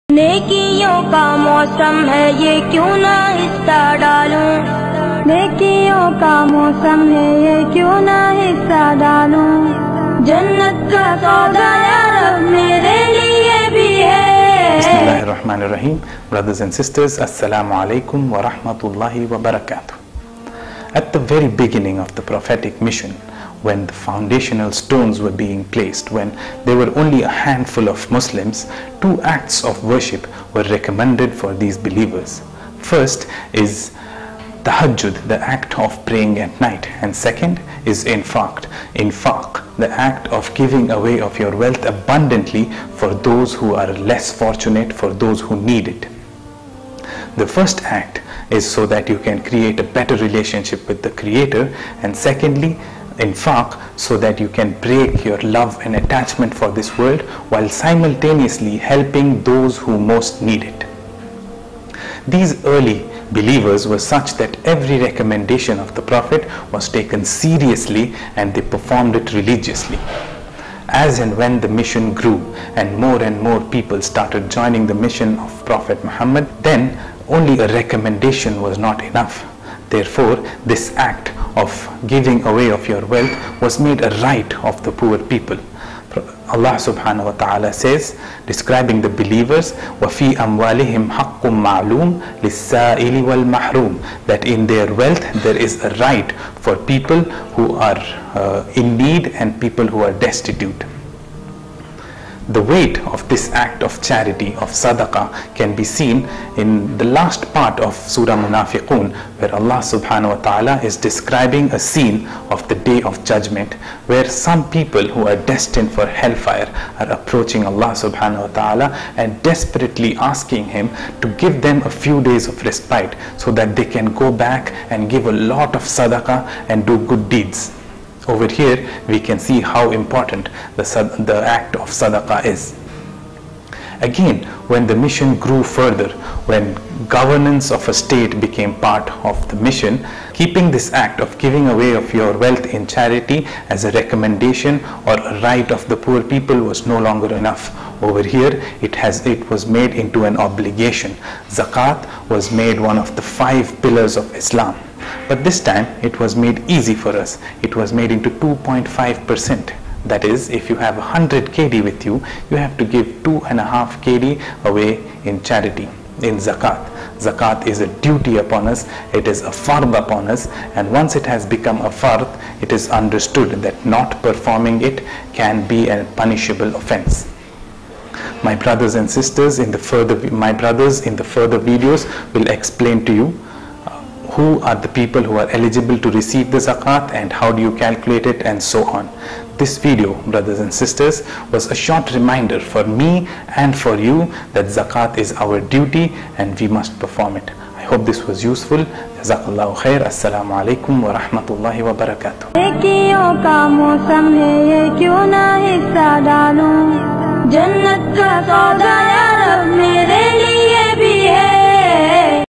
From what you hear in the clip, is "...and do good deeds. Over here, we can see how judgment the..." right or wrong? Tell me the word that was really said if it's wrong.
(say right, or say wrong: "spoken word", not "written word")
wrong: "important", not "judgment".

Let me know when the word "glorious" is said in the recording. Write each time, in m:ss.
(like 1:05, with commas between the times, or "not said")
not said.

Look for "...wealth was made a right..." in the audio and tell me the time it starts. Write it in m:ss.
1:23.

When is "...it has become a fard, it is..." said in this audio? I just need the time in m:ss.
2:51.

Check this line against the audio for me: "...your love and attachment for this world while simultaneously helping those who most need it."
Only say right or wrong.
right.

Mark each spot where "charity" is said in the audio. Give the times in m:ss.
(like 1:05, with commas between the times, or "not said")
1:44, 2:22, 2:45.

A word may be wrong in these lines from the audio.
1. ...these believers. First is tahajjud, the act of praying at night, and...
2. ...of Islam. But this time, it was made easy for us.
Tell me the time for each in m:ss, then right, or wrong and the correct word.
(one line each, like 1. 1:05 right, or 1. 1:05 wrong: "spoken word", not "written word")
1. 0:31 right
2. 2:34 right.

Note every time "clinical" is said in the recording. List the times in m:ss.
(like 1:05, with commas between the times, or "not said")
not said.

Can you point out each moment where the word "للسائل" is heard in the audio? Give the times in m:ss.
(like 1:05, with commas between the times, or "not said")
1:32.